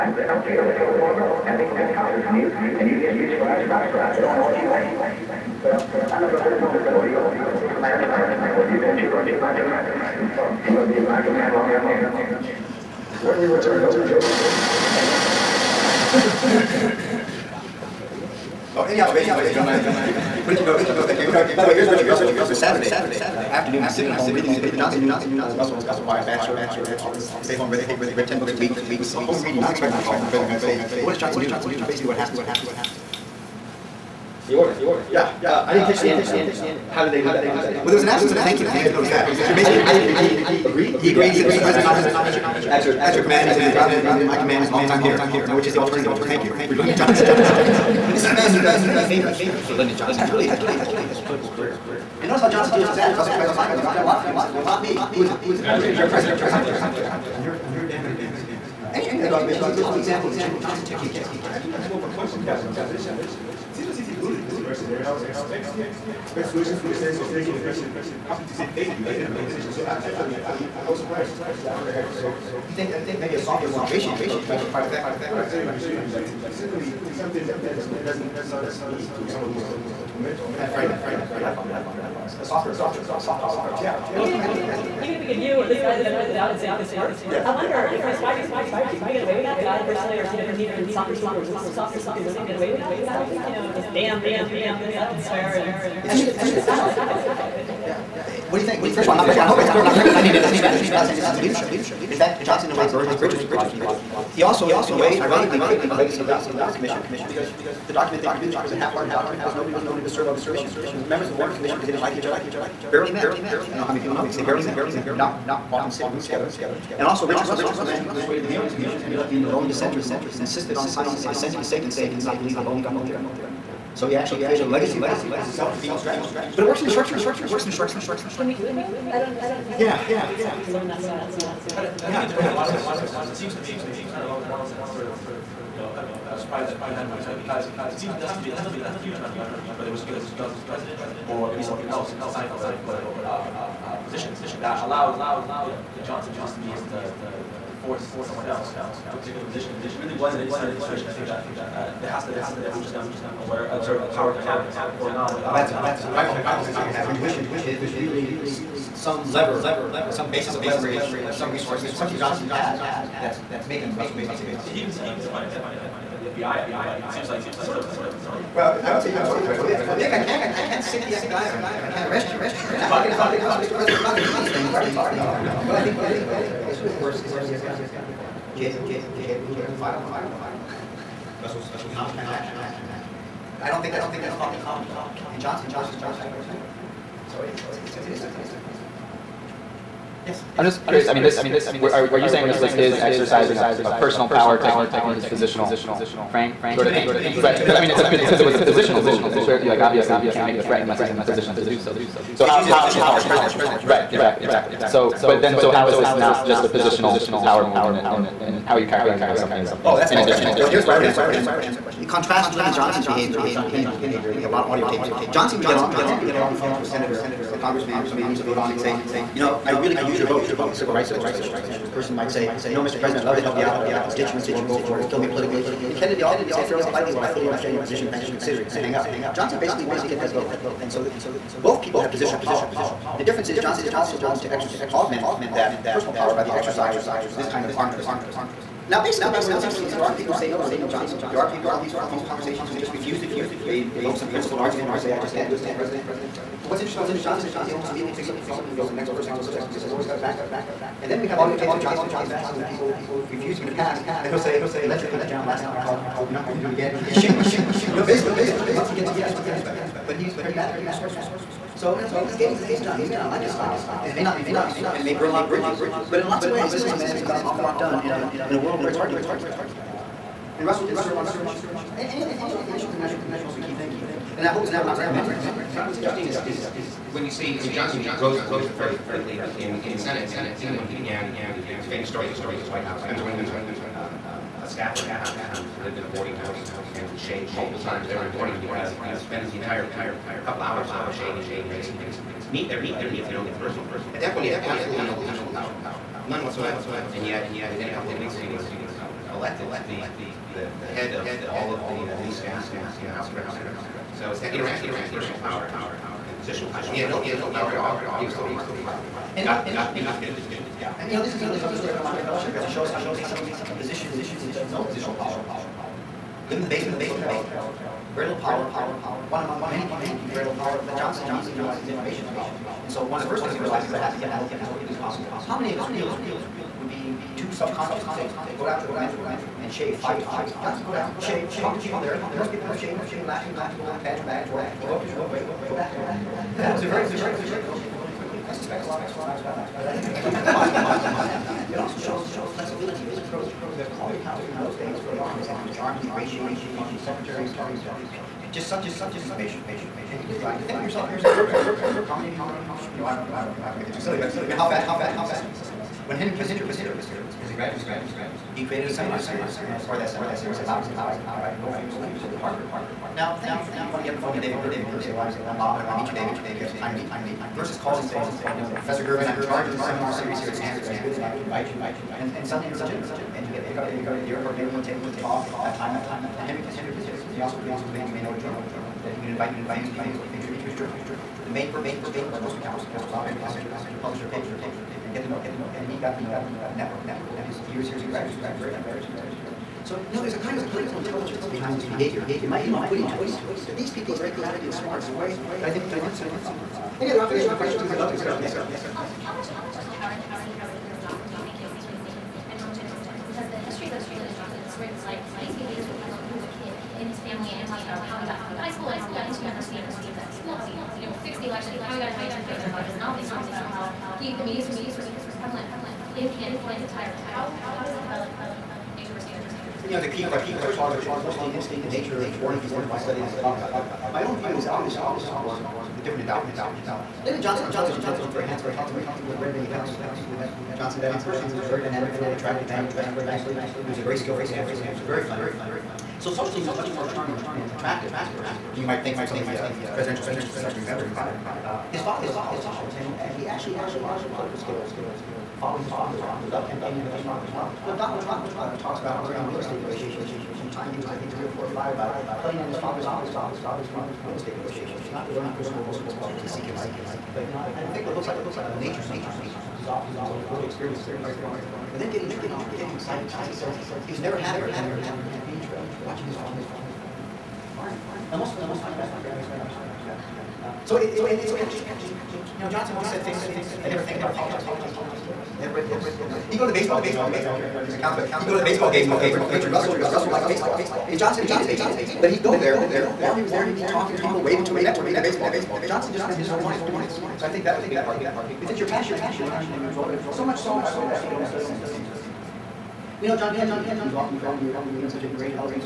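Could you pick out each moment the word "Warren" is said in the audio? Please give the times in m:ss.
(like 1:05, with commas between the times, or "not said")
1:46, 1:51.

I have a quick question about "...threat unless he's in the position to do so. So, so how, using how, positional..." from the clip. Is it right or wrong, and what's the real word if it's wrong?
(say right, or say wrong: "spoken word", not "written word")
right.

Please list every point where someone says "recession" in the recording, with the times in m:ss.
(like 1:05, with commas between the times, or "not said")
not said.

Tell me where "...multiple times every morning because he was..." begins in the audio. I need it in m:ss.
4:47.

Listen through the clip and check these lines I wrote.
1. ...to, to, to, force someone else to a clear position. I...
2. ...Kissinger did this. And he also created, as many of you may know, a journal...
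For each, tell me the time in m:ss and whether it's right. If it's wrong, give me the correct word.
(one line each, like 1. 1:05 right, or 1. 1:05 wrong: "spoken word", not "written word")
1. 2:26 wrong: "particular", not "clear"
2. 6:16 right.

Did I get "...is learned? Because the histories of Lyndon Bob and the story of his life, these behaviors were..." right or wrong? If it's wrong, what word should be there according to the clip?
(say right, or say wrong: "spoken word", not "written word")
wrong: "Johnson", not "Bob".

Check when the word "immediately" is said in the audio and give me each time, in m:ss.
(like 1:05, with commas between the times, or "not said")
4:07, 5:21.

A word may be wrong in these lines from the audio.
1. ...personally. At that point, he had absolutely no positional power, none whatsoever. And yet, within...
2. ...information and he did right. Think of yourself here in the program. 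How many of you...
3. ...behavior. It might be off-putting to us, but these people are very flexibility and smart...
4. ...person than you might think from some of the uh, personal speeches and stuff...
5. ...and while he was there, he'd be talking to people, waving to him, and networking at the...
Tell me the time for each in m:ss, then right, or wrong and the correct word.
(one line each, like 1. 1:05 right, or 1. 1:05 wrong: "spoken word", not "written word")
1. 4:53 right
2. 5:49 right
3. 6:31 wrong: "crafty", not "flexibility"
4. 7:18 wrong: "presidential", not "personal"
5. 8:02 right.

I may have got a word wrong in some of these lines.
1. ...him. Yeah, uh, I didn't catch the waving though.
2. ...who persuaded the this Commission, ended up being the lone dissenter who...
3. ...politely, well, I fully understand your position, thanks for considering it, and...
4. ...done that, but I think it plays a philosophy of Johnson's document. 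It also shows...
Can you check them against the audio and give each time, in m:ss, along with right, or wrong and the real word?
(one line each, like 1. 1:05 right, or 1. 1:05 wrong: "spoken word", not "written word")
1. 0:34 wrong: "ending", not "waving"
2. 1:58 right
3. 3:46 right
4. 5:39 wrong: "ascent", not "document".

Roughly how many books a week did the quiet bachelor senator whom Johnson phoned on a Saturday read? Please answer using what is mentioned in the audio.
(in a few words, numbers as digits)
10.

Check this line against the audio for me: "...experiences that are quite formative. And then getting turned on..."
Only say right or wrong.
right.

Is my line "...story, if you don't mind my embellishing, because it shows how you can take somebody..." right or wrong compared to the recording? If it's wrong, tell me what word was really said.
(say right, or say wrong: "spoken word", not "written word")
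right.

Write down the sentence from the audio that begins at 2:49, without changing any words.
Now, Dick, I can't, I can't sick the FBI on you, and I can't arrest you.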